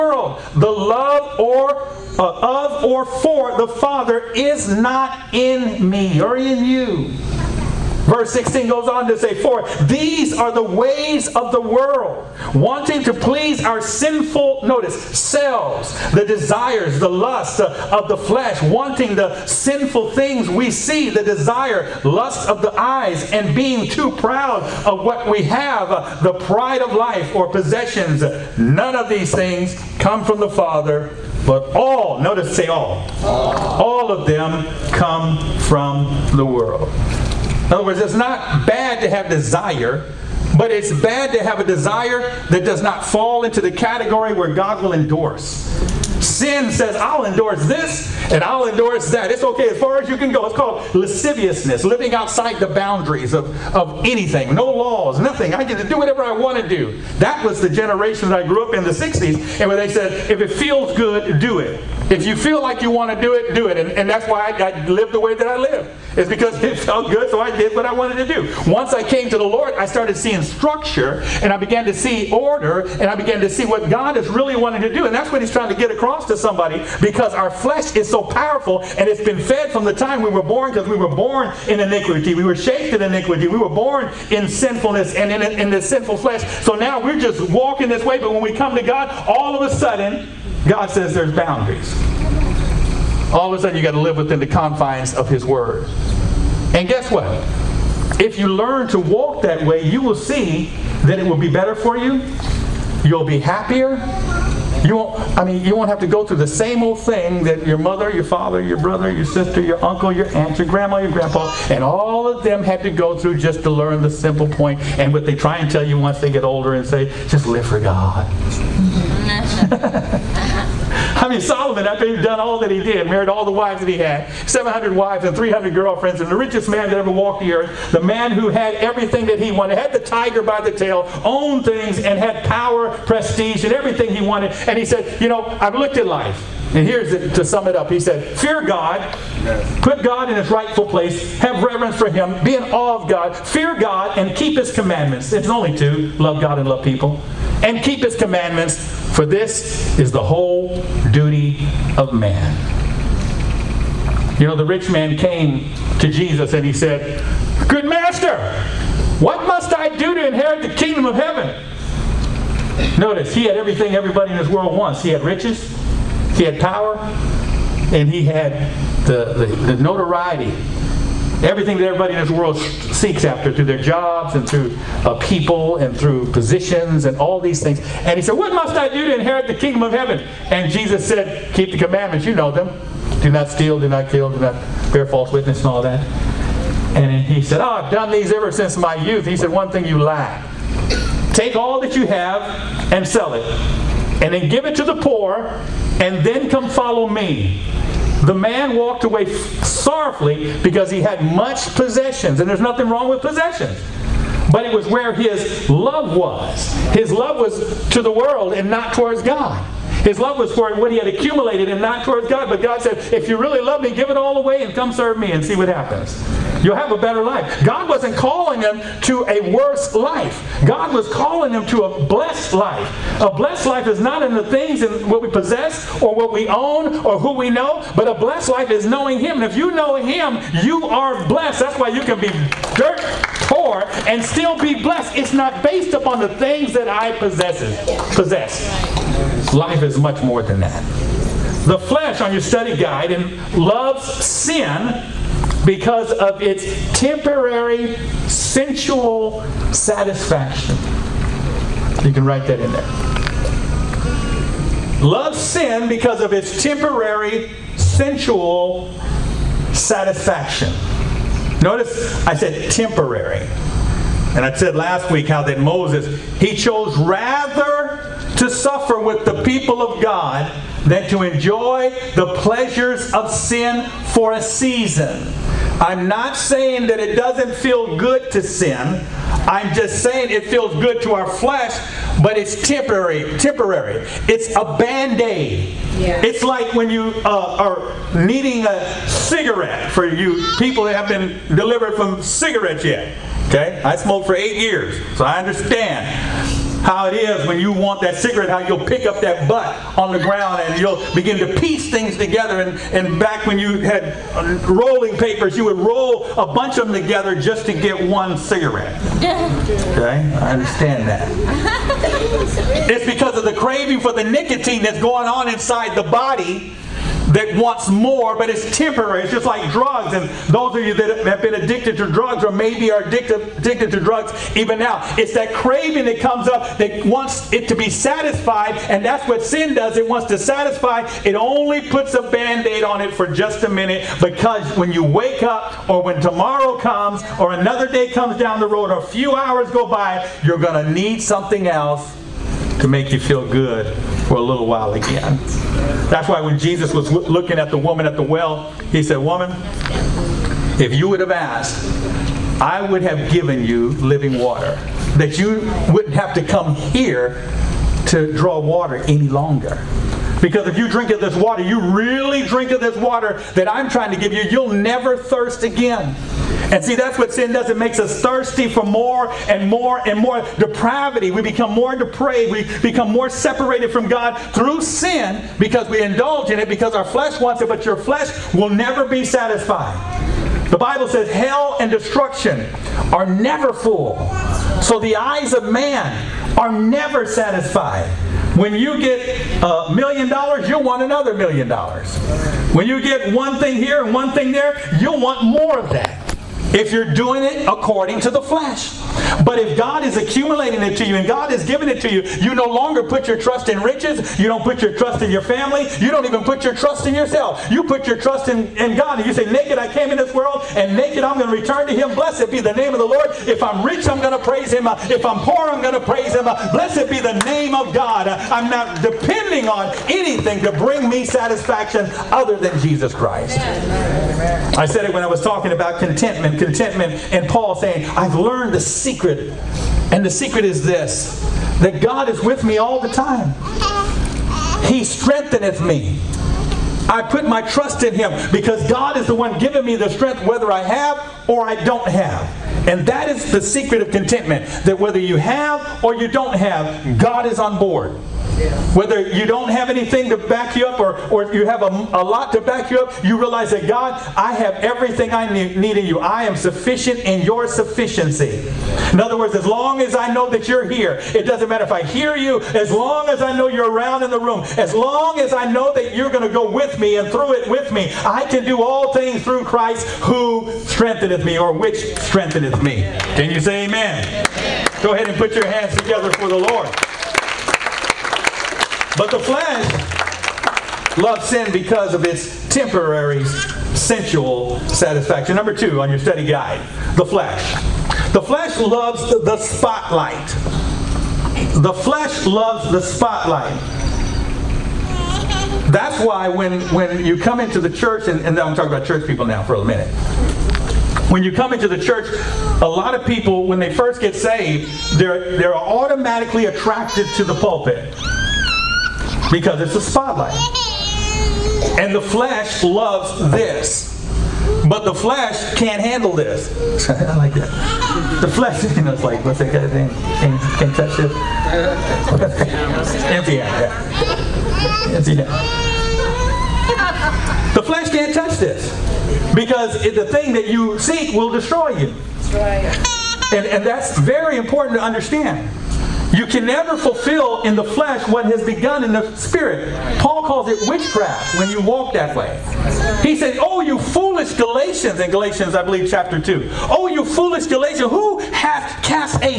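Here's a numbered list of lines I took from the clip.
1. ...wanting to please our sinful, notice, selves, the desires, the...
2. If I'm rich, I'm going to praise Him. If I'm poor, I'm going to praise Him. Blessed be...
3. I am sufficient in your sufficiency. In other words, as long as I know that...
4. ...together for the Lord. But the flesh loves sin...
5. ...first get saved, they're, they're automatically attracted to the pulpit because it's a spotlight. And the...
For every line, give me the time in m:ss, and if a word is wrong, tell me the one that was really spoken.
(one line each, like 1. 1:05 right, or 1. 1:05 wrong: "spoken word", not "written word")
1. 0:12 right
2. 6:53 right
3. 7:36 right
4. 7:55 right
5. 8:23 right.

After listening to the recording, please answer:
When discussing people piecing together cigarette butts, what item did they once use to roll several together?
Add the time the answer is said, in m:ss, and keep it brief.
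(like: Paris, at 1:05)
rolling papers, at 5:04.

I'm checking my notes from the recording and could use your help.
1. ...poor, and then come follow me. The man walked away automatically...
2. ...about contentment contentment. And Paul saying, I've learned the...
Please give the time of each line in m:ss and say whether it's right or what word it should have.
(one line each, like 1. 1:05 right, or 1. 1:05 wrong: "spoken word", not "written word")
1. 3:14 wrong: "sorrowfully", not "automatically"
2. 7:05 right.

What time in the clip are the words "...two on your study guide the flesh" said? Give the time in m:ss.
8:05.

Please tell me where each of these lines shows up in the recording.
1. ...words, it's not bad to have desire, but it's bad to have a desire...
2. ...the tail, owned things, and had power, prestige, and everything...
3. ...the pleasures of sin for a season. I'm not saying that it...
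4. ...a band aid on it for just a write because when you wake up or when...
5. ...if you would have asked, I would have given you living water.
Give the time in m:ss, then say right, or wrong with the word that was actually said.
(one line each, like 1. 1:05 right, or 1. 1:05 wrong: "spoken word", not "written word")
1. 0:37 right
2. 2:10 right
3. 4:32 right
4. 5:32 wrong: "minute", not "write"
5. 5:50 right.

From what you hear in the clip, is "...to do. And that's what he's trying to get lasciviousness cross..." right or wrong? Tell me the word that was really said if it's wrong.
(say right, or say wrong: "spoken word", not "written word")
wrong: "across", not "lasciviousness".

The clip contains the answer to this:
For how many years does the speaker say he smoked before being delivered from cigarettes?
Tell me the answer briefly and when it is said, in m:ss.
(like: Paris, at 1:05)
8, at 4:54.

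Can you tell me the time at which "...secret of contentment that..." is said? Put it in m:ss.
7:23.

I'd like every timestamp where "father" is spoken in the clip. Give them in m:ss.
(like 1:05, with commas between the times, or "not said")
0:03, 0:30, 1:48.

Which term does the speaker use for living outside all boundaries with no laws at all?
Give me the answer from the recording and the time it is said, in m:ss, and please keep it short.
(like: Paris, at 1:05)
lasciviousness, at 0:50.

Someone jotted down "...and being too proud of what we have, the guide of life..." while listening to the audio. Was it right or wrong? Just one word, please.
wrong.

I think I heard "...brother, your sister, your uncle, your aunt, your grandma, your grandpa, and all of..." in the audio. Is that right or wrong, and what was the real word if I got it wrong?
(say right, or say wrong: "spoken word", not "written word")
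right.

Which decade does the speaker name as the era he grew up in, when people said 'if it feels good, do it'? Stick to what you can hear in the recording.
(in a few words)
the 60s.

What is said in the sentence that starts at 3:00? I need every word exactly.
And Jesus said, Keep the commandments.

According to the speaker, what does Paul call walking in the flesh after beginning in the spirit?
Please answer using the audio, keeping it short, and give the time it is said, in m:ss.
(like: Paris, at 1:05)
witchcraft, at 9:00.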